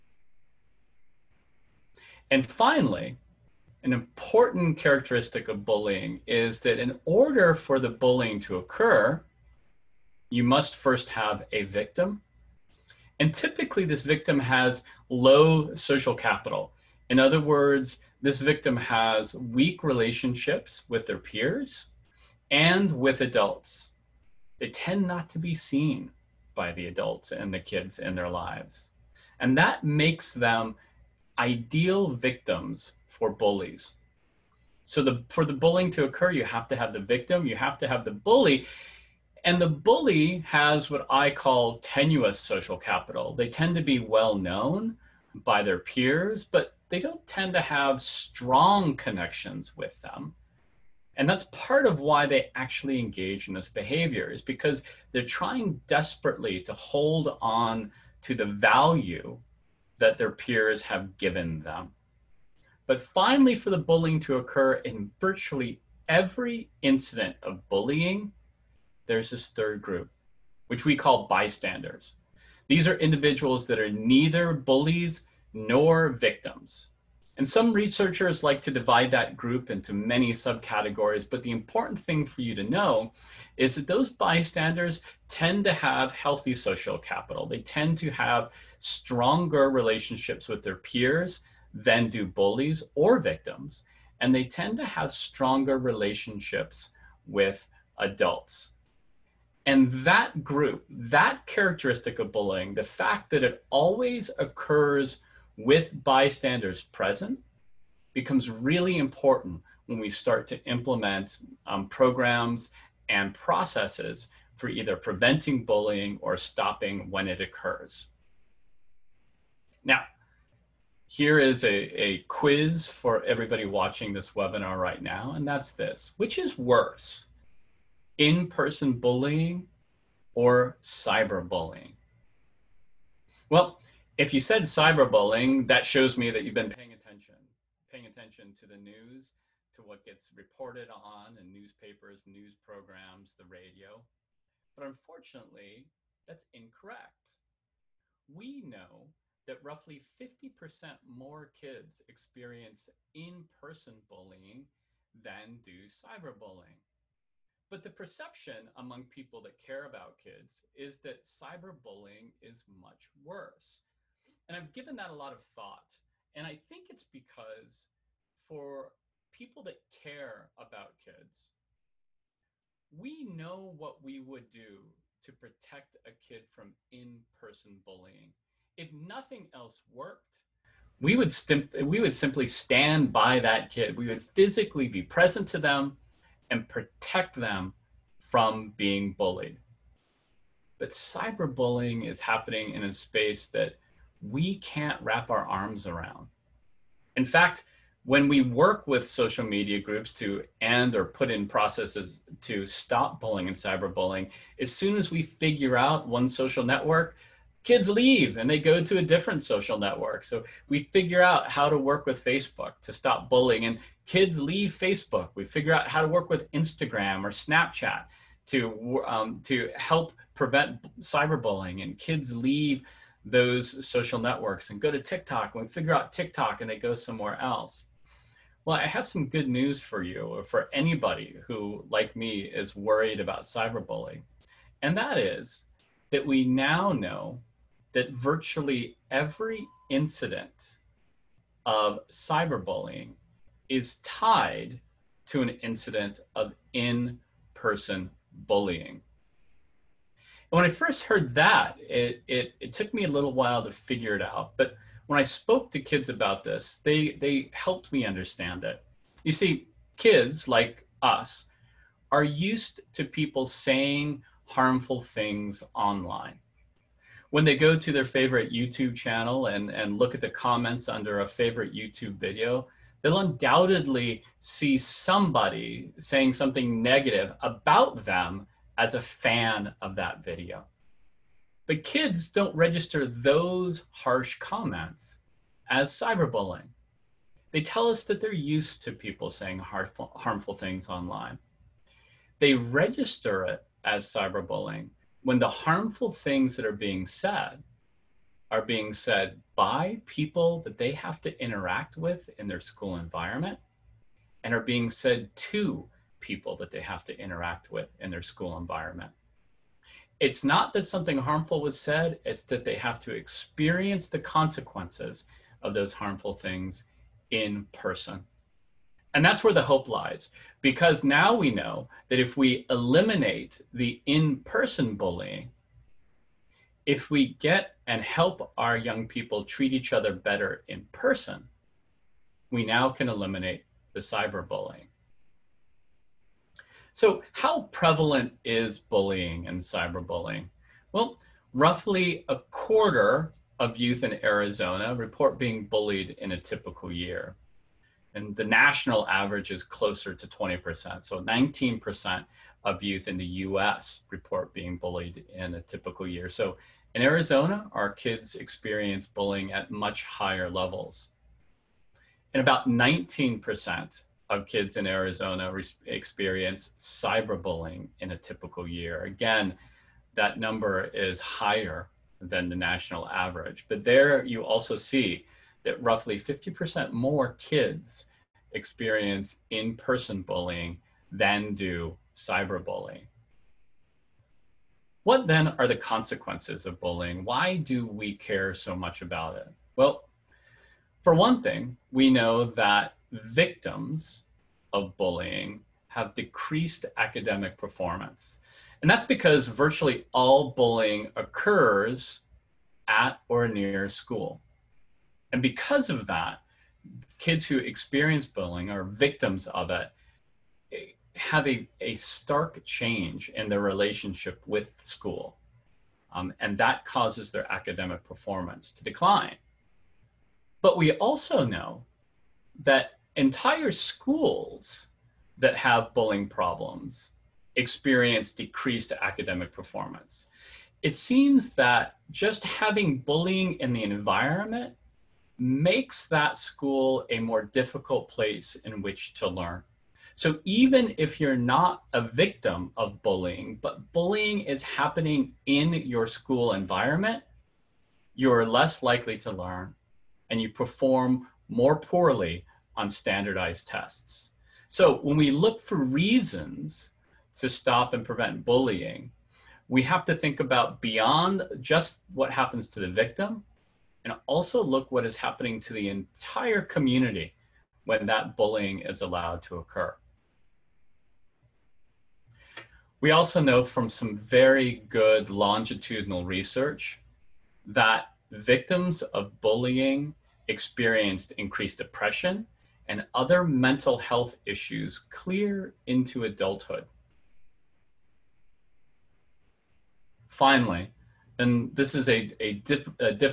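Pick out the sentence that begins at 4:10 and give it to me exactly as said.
And when I first heard that, it, it, it, took me a little while to figure it out.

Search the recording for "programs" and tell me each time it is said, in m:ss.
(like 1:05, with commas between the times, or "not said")
1:51, 2:22.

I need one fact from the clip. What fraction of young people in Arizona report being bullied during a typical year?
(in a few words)
a quarter.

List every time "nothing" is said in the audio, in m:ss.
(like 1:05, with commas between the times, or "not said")
2:58.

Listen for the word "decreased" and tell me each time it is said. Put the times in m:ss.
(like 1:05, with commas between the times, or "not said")
6:36, 7:08.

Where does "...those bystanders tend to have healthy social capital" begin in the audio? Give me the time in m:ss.
1:23.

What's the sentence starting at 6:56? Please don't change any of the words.
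Um, and that causes their academic performance to decline.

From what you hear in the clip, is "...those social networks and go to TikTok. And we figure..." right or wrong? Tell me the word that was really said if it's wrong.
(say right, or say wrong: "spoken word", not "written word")
right.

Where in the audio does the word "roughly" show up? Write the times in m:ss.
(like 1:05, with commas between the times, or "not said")
2:29, 5:41, 6:15.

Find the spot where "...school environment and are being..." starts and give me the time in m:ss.
5:02.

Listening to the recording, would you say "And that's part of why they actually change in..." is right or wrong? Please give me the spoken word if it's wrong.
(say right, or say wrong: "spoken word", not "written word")
wrong: "engage", not "change".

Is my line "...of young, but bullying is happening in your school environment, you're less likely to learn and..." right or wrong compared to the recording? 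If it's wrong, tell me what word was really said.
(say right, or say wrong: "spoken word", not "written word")
wrong: "bullying", not "young".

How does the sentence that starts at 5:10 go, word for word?
It's not that something harmful was said, it's that they have to experience the consequences of those harmful things in person.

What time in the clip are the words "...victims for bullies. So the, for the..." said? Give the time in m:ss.
0:32.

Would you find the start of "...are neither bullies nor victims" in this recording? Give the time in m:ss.
1:13.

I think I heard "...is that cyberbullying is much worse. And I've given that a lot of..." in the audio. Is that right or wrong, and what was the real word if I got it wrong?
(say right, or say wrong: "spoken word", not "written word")
right.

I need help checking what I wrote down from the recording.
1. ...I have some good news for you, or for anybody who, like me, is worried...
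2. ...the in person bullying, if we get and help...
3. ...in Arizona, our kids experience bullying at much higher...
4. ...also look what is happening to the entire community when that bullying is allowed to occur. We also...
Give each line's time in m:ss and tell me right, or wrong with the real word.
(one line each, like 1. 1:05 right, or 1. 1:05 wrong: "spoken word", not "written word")
1. 3:48 right
2. 5:23 right
3. 5:56 right
4. 7:44 right.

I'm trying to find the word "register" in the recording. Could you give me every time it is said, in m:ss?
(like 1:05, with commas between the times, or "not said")
4:42, 4:52.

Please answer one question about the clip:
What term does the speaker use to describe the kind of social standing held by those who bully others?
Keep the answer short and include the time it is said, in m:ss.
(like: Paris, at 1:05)
tenuous social capital, at 0:41.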